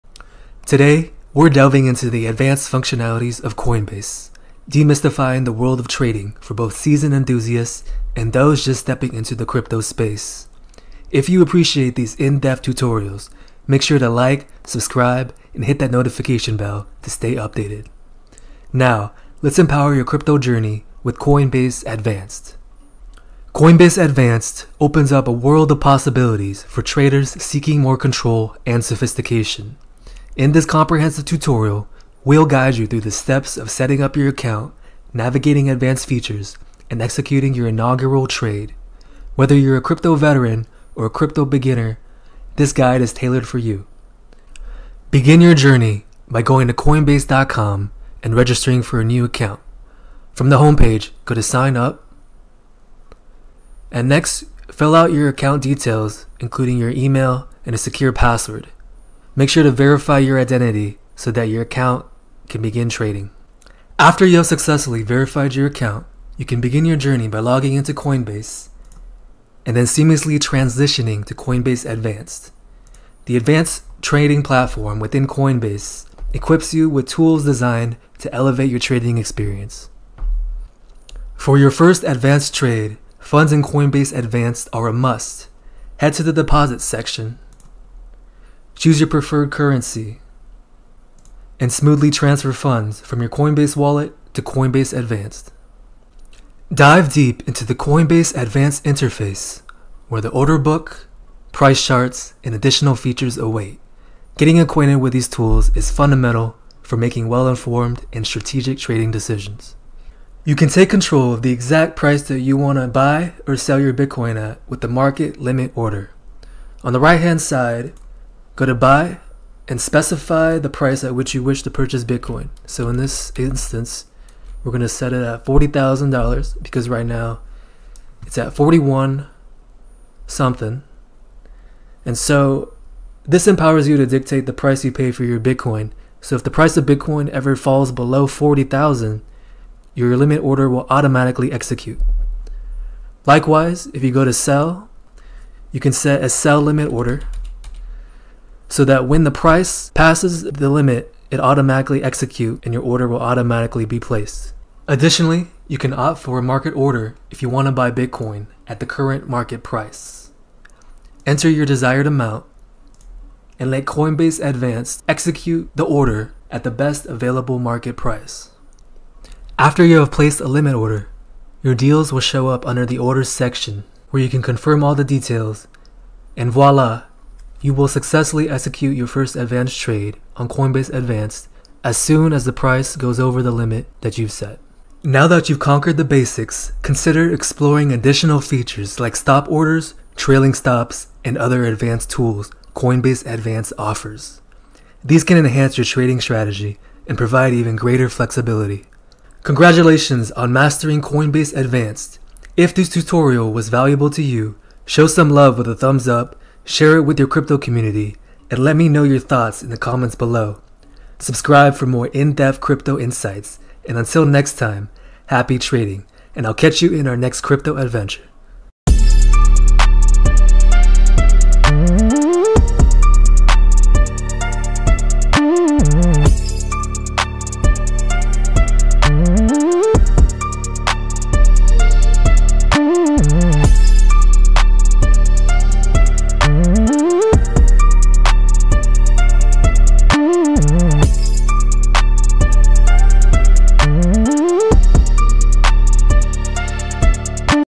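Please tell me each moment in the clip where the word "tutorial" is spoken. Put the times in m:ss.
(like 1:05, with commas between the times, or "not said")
0:12, 0:31, 3:22.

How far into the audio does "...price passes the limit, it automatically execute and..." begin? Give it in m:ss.
2:29.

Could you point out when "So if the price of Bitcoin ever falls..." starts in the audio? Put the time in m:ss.
2:16.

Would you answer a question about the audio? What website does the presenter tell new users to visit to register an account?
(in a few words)
coinbase.com.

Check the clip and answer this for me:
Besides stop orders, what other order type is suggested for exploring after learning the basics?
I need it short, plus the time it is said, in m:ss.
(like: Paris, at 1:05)
trailing stops, at 3:10.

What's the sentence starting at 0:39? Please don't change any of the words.
Whether you're a crypto veteran or a crypto beginner, this guide is tailored for you.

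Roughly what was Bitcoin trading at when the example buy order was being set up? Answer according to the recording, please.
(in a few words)
41 something.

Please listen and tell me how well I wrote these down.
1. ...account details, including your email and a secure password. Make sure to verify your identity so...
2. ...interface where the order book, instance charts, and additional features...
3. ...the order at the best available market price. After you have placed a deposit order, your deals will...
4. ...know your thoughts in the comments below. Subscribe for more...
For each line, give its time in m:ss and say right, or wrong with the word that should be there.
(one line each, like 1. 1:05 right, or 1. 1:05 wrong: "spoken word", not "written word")
1. 0:55 right
2. 1:38 wrong: "price", not "instance"
3. 2:45 wrong: "limit", not "deposit"
4. 3:28 right.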